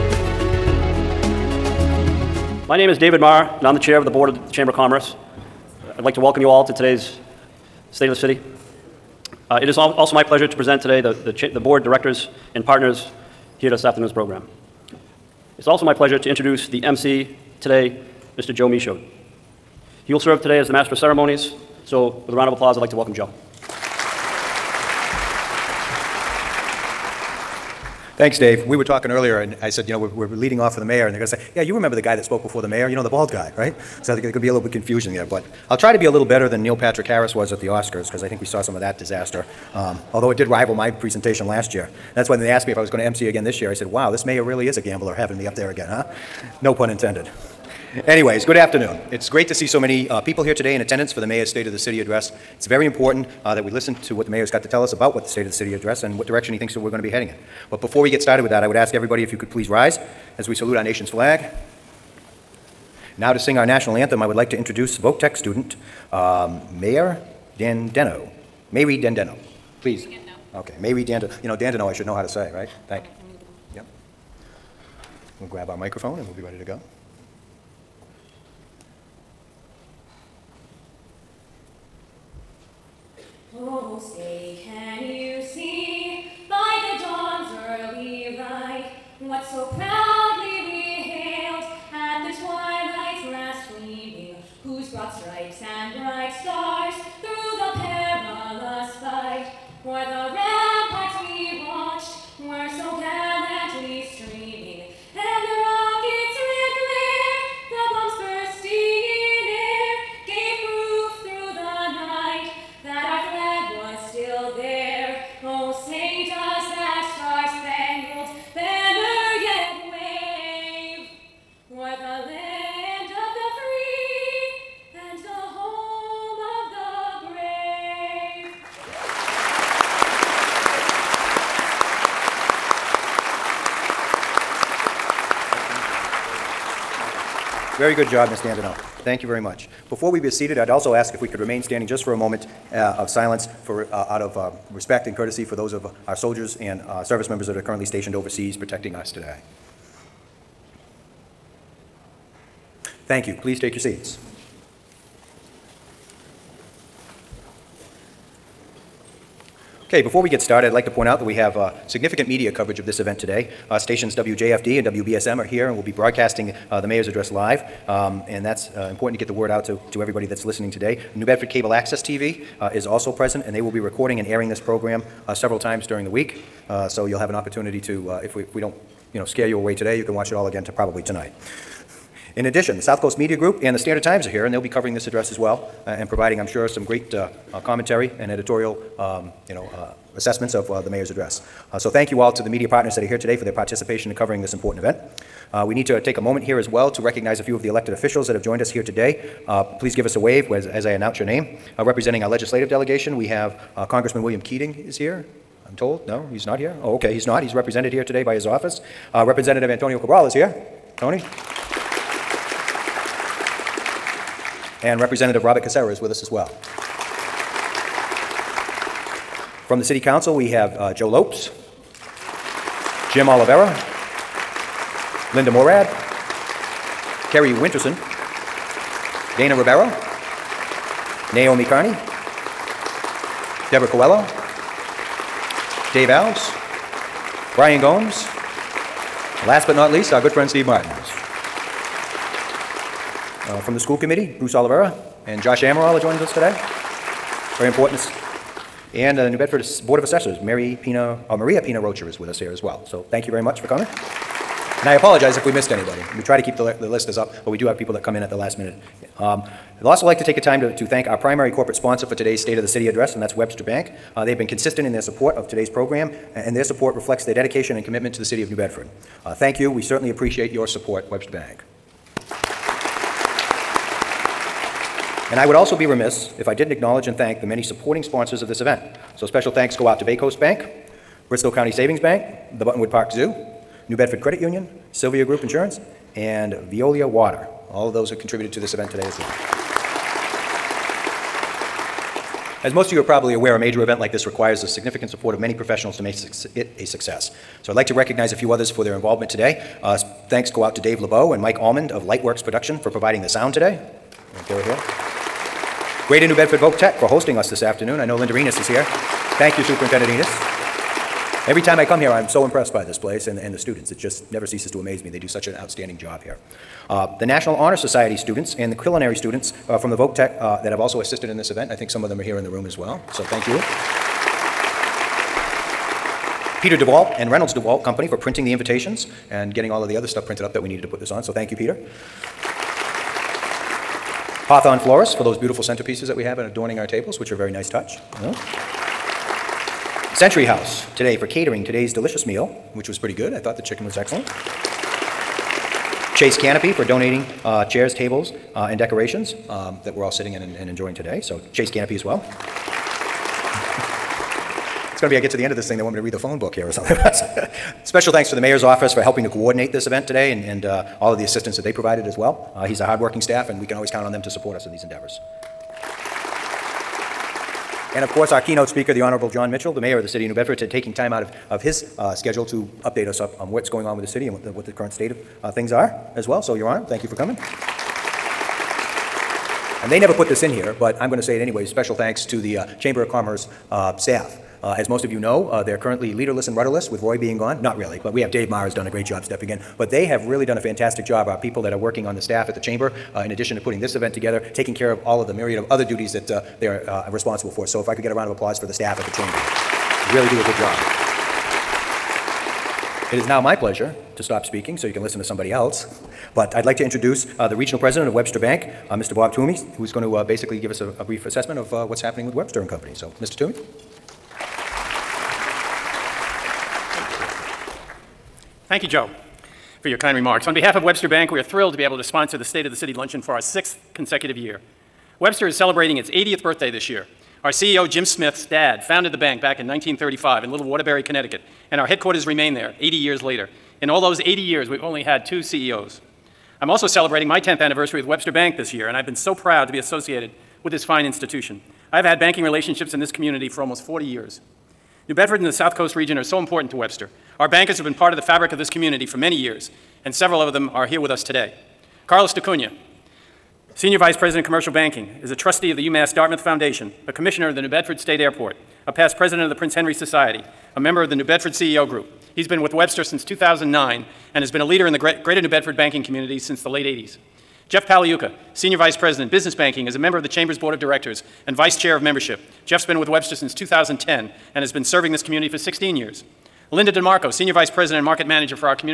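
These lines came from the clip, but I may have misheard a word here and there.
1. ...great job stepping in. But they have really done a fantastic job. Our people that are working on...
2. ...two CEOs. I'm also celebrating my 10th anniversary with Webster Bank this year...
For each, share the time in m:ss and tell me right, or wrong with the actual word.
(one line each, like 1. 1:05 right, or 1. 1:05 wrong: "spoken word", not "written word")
1. 6:28 right
2. 7:15 right.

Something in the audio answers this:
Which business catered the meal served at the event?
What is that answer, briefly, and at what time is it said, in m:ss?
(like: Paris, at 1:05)
Century House, at 5:40.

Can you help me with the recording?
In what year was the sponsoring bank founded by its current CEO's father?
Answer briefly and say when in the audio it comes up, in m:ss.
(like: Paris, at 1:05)
1935, at 7:09.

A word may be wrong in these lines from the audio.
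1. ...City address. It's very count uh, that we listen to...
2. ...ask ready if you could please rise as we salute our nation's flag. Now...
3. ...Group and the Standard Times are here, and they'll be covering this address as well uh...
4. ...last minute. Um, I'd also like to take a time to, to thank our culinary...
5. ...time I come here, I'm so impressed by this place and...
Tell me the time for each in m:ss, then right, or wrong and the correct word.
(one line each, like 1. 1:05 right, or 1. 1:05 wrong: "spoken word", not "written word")
1. 0:51 wrong: "important", not "count"
2. 0:58 wrong: "everybody", not "ready"
3. 3:03 right
4. 4:18 wrong: "primary", not "culinary"
5. 5:11 right.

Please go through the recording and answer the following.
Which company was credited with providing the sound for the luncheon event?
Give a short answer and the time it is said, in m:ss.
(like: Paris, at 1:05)
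Lightworks Production, at 5:02.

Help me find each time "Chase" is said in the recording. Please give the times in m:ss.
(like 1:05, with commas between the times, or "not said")
5:46, 5:51.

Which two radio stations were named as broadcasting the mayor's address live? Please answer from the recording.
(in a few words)
WJFD and WBSM.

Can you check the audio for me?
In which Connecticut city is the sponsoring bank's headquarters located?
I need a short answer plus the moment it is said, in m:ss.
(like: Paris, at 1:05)
Waterbury, at 7:10.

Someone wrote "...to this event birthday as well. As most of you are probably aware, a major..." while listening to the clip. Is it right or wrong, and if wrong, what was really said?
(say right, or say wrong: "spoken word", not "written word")
wrong: "today", not "birthday".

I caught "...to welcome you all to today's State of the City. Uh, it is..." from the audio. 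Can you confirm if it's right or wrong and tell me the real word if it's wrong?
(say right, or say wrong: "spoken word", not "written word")
right.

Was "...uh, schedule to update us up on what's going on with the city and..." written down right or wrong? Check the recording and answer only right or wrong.
right.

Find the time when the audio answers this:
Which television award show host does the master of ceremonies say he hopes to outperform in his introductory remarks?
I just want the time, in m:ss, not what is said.
0:36.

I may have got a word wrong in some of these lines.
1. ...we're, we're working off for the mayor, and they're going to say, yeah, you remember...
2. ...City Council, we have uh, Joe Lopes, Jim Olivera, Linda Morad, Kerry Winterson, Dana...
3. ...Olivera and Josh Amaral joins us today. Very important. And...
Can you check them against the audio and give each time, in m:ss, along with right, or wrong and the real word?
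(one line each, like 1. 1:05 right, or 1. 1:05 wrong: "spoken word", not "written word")
1. 0:29 wrong: "leading", not "working"
2. 3:39 right
3. 4:04 right.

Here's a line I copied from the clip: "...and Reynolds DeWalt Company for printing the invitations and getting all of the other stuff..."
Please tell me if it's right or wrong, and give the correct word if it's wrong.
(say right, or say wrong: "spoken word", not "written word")
right.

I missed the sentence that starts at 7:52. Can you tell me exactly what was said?
Jeff's been with Webster since 2010 and has been serving this community for 16 years.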